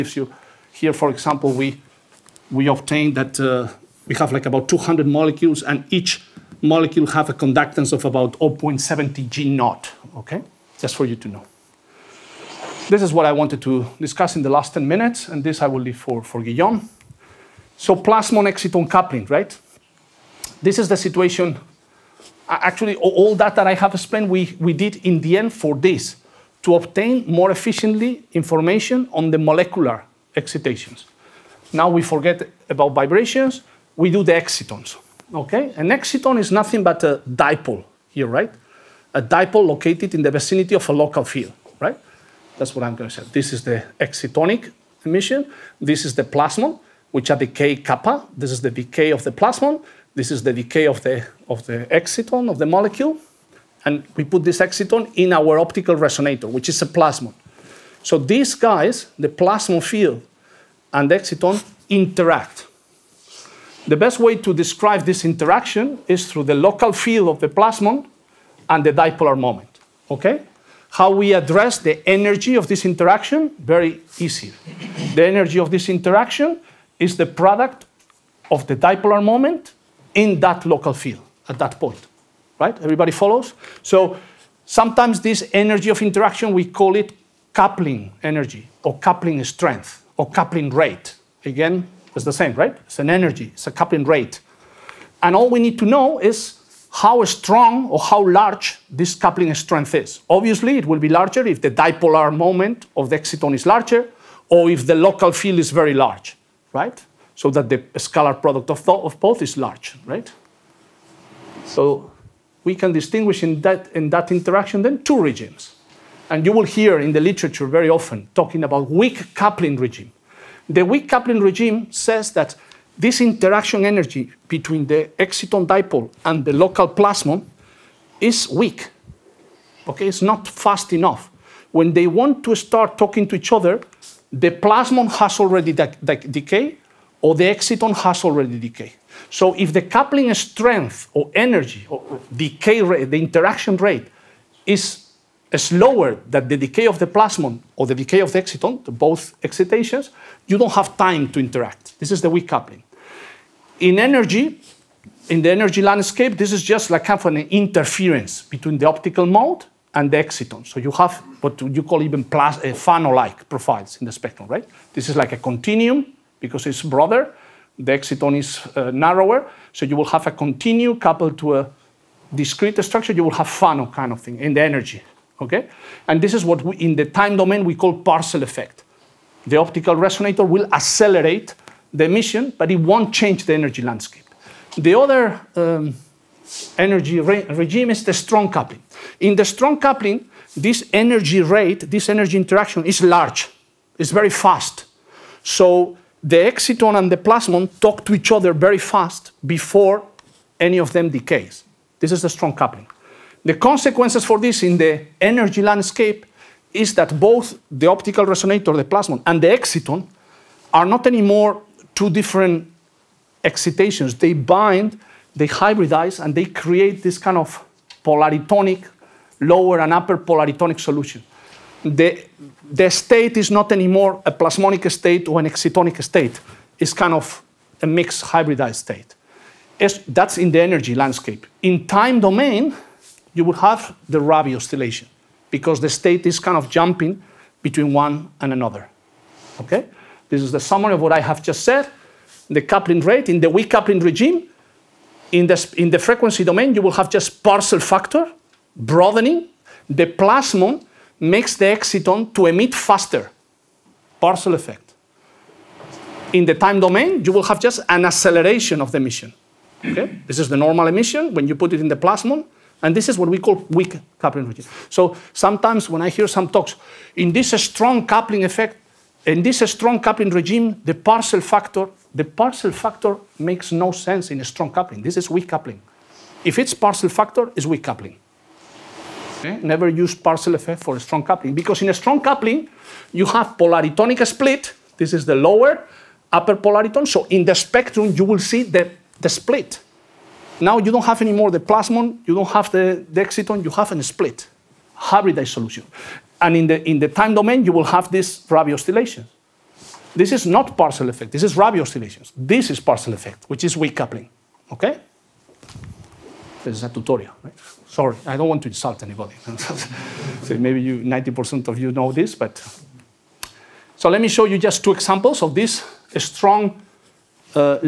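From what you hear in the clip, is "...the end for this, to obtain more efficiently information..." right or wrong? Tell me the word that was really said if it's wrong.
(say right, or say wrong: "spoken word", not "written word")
right.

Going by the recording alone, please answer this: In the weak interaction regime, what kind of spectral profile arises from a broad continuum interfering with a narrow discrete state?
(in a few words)
Fano-like profiles.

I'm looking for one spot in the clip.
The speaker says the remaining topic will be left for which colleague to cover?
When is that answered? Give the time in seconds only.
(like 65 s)
16 s.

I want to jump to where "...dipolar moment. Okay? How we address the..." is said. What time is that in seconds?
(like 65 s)
68 s.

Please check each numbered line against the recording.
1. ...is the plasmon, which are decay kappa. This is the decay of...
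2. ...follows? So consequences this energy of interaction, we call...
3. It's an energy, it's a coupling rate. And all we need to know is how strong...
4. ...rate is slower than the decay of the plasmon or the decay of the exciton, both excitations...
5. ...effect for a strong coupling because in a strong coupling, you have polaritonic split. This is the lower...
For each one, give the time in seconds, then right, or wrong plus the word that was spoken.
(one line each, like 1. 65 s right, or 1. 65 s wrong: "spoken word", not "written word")
1. 46 s right
2. 83 s wrong: "sometimes", not "consequences"
3. 92 s right
4. 143 s right
5. 280 s right.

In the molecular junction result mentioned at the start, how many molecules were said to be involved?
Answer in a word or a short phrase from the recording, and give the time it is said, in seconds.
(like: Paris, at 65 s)
200, at 4 s.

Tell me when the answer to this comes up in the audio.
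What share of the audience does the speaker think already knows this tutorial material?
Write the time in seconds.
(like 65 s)
310 s.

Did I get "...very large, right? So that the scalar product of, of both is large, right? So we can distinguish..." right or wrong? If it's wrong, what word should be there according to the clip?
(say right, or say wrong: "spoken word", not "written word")
right.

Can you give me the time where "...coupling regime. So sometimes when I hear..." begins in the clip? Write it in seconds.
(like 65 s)
264 s.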